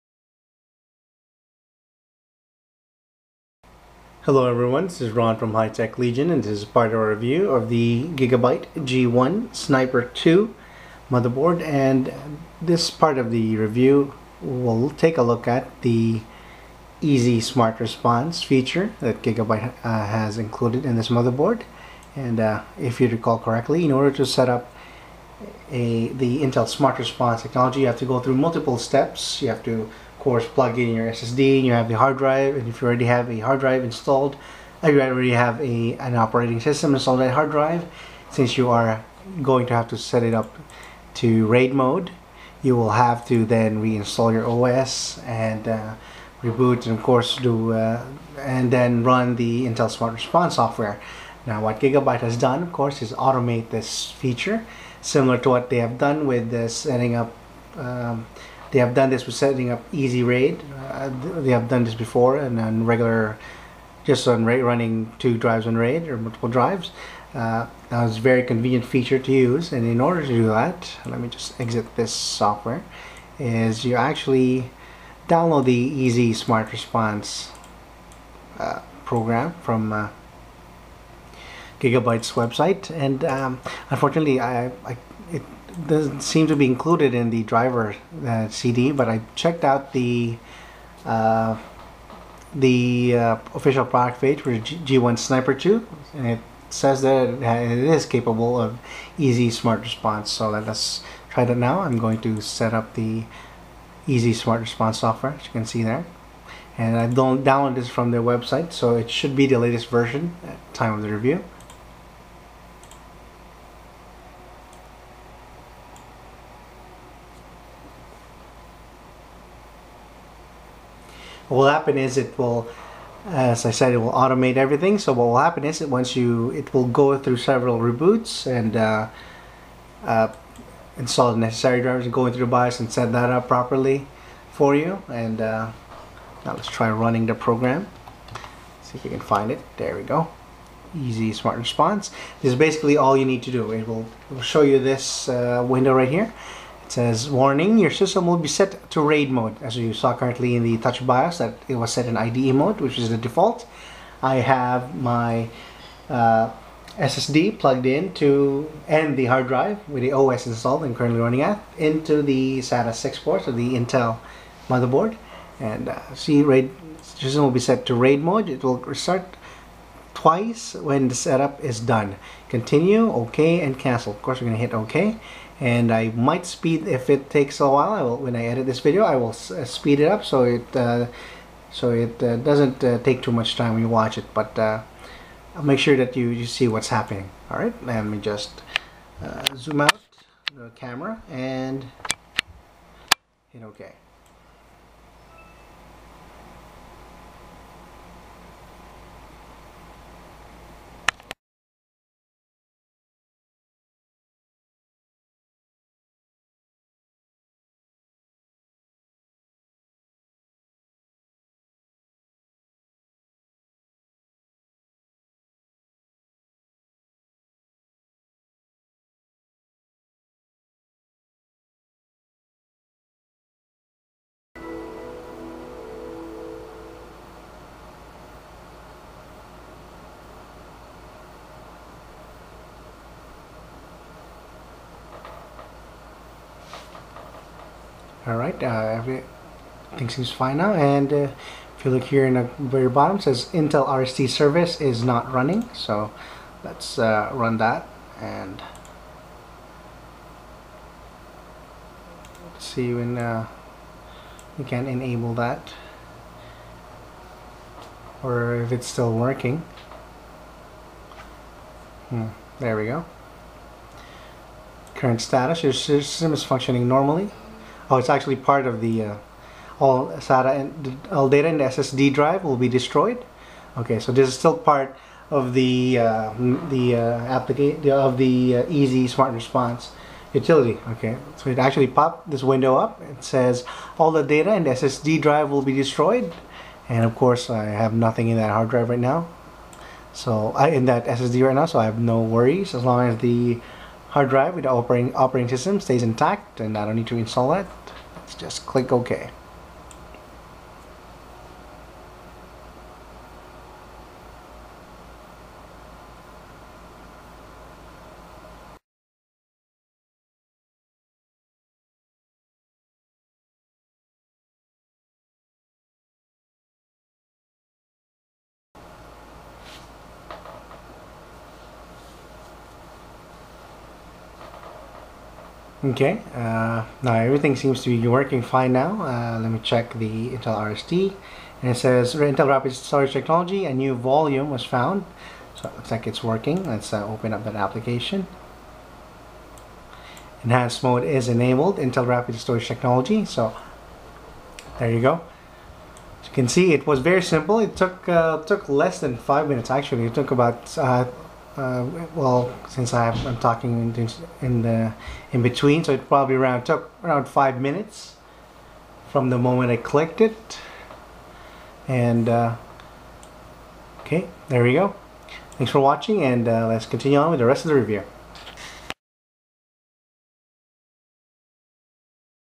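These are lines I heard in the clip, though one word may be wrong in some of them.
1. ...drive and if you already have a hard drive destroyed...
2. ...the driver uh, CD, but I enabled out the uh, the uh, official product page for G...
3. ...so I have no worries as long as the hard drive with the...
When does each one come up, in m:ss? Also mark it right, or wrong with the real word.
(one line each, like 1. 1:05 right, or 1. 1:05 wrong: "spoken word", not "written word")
1. 0:32 wrong: "installed", not "destroyed"
2. 1:27 wrong: "checked", not "enabled"
3. 4:51 right.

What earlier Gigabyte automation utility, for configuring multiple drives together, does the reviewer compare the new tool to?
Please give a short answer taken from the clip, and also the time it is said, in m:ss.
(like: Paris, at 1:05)
Easy Raid, at 0:59.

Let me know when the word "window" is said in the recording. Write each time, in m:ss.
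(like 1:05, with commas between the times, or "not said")
2:25, 4:42.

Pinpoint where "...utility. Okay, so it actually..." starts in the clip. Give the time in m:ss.
4:40.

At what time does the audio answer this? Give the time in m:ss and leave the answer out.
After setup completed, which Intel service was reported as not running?
4:03.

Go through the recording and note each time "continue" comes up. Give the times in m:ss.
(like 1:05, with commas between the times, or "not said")
2:52, 6:06.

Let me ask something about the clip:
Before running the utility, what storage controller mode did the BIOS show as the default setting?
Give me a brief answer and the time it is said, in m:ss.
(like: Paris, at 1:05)
IDE mode, at 2:32.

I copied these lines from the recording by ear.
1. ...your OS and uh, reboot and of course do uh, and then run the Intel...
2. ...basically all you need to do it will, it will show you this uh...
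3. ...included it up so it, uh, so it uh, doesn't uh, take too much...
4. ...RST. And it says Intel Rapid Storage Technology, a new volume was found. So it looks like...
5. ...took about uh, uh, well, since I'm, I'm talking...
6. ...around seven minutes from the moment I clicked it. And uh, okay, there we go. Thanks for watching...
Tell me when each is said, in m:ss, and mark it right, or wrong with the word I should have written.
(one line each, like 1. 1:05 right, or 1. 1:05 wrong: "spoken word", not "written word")
1. 0:44 right
2. 2:22 right
3. 2:59 wrong: "speed", not "included"
4. 5:30 right
5. 5:50 right
6. 5:57 wrong: "five", not "seven".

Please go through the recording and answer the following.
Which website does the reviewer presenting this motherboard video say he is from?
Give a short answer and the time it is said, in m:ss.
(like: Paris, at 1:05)
HiTechLegion, at 0:05.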